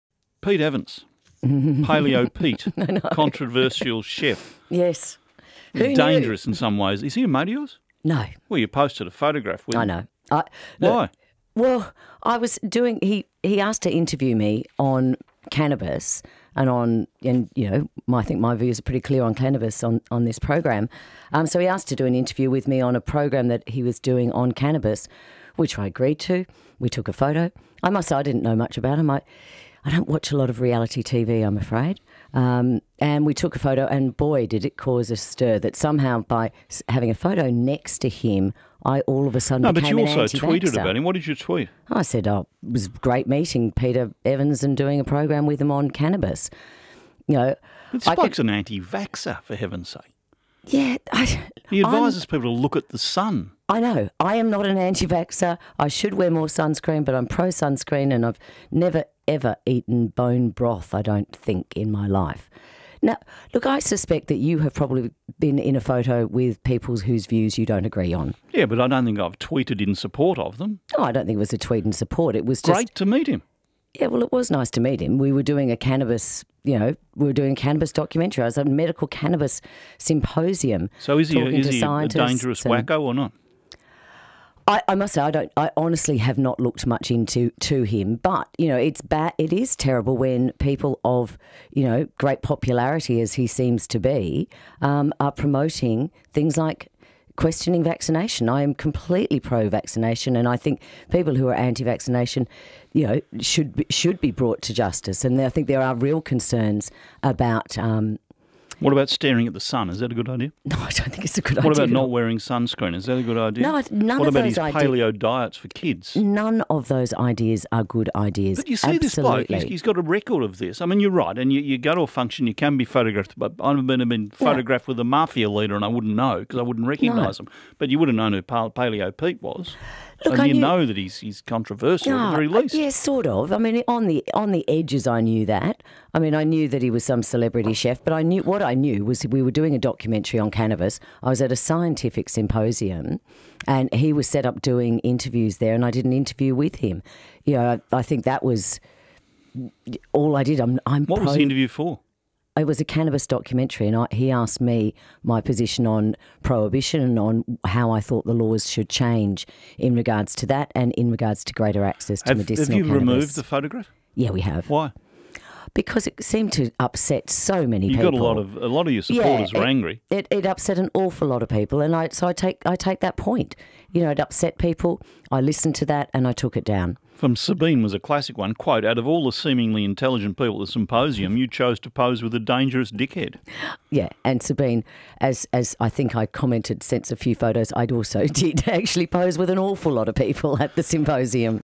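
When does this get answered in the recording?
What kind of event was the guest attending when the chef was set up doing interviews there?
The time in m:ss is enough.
1:18.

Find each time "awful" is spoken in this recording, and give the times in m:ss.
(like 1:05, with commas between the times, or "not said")
2:50, 3:09.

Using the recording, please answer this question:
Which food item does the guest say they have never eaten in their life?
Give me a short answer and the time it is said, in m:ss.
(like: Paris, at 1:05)
Bone broth, at 1:00.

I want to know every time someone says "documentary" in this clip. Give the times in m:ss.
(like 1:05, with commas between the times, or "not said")
1:17, 2:19, 2:33.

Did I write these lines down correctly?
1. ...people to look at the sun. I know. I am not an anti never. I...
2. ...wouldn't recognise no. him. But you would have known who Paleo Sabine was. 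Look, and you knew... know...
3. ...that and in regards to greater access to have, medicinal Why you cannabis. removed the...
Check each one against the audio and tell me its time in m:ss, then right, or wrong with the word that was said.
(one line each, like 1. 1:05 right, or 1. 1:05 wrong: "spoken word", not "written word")
1. 0:52 wrong: "vaxxer", not "never"
2. 2:06 wrong: "Pete", not "Sabine"
3. 2:40 wrong: "Have", not "Why".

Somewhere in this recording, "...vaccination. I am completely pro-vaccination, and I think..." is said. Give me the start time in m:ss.
1:37.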